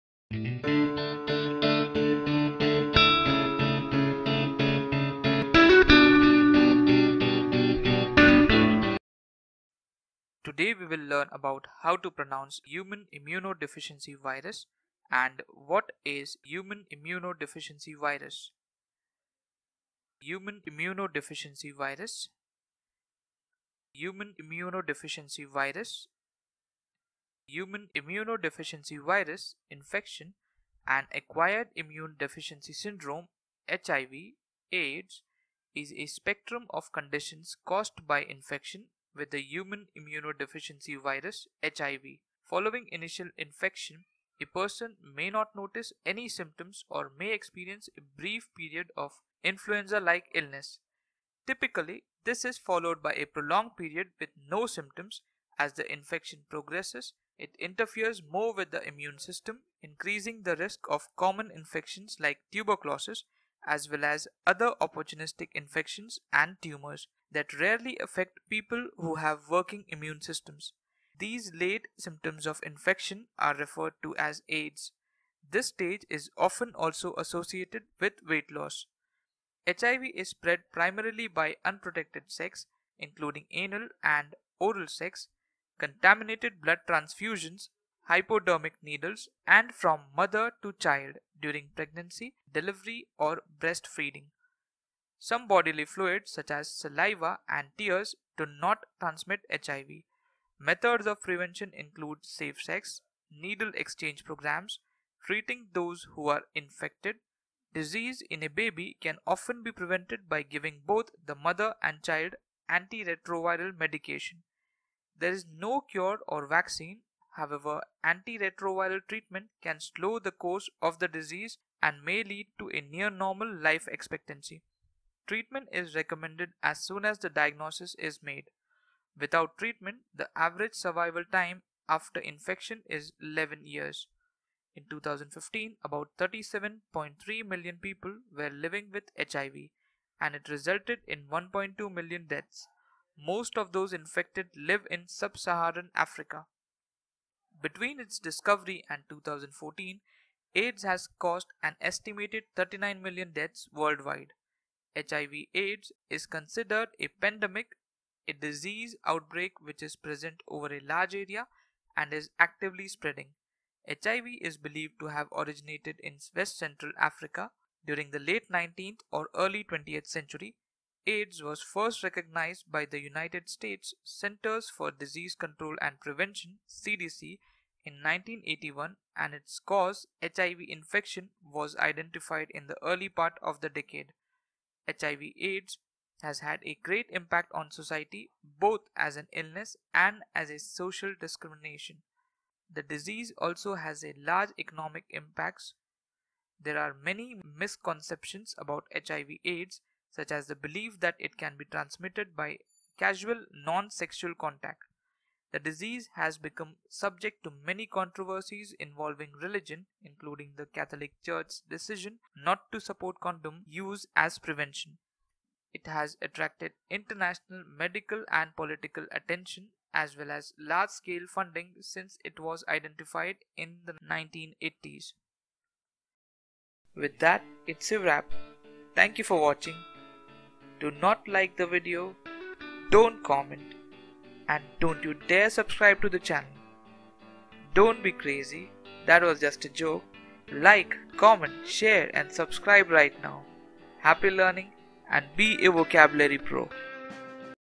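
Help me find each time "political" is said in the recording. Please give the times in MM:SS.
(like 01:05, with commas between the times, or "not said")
03:38.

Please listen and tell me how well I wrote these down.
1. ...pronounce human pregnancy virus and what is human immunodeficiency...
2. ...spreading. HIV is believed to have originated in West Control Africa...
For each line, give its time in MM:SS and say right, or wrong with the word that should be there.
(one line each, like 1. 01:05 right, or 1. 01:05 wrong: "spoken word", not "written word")
1. 00:12 wrong: "immunodeficiency", not "pregnancy"
2. 02:42 wrong: "Central", not "Control".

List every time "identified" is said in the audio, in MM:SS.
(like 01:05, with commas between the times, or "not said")
03:01, 03:42.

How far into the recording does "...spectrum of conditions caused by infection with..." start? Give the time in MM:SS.
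00:36.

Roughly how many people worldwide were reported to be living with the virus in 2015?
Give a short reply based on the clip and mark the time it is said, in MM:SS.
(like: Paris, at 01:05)
37.3 million, at 02:16.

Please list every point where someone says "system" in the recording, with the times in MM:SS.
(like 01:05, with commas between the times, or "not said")
00:59, 01:10.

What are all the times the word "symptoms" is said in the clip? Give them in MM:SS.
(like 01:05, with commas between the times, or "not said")
00:46, 00:54, 01:11.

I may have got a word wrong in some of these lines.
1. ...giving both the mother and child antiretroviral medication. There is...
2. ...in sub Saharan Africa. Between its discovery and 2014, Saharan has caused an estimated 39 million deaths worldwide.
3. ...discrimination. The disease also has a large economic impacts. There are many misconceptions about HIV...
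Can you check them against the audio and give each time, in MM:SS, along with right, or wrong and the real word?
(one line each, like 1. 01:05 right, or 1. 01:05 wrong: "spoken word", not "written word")
1. 01:50 right
2. 02:24 wrong: "AIDS", not "Saharan"
3. 03:11 right.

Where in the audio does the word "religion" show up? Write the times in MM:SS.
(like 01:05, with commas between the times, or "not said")
03:29.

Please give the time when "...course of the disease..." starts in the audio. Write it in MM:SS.
02:00.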